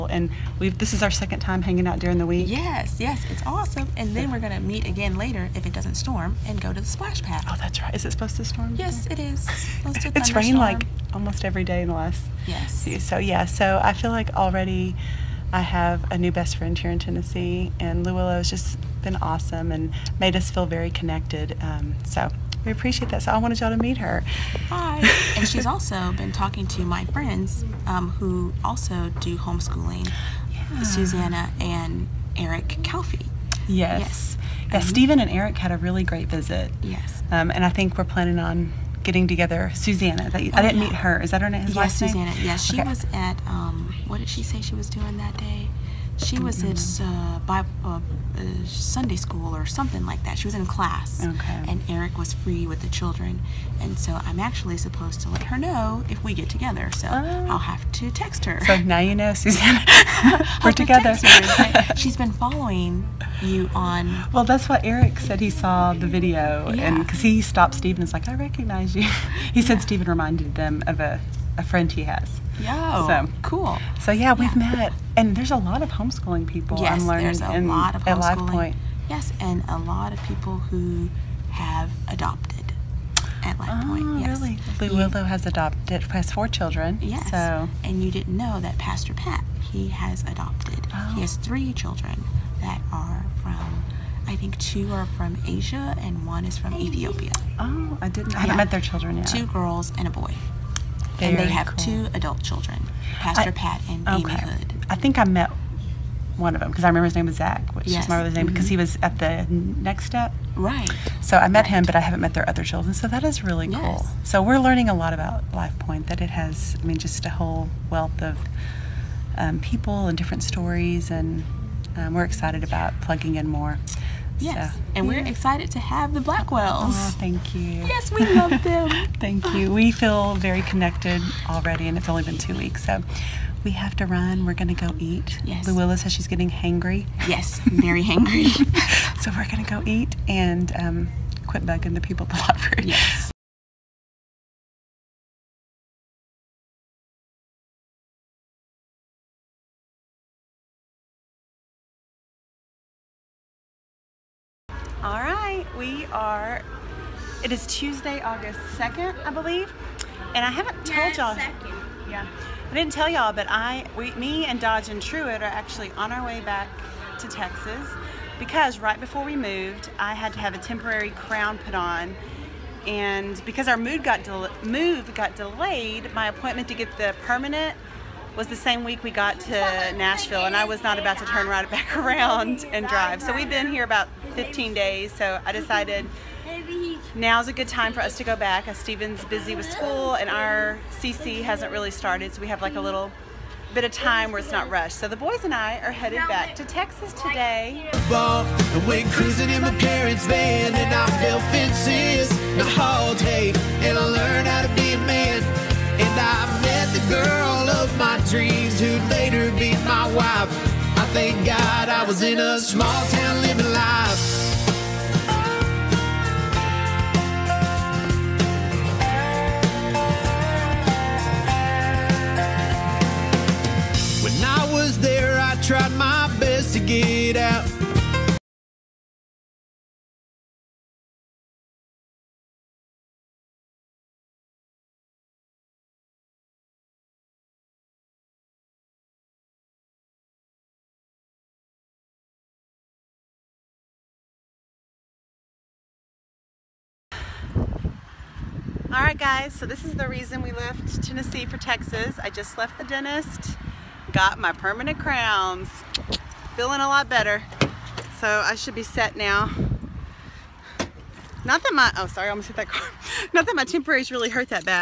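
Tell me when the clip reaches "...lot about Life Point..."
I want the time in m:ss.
1:54.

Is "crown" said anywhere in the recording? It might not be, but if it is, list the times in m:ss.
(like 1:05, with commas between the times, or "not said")
2:51, 4:14.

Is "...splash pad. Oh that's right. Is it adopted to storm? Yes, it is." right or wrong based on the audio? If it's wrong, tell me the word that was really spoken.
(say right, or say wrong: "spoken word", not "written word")
wrong: "supposed", not "adopted".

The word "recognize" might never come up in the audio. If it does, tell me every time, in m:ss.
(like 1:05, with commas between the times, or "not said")
1:08.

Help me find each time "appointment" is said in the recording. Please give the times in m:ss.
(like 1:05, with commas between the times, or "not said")
2:56.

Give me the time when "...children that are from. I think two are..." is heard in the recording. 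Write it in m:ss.
1:31.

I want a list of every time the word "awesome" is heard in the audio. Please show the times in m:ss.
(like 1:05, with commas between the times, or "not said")
0:03, 0:19.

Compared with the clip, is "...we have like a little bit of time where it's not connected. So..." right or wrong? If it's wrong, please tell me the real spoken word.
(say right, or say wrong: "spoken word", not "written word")
wrong: "rushed", not "connected".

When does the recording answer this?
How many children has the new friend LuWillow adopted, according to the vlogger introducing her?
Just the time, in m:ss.
1:26.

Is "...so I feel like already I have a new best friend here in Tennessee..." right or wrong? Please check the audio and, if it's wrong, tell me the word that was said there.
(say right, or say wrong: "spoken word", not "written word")
right.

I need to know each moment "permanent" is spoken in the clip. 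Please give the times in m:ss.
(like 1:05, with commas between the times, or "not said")
2:57, 4:14.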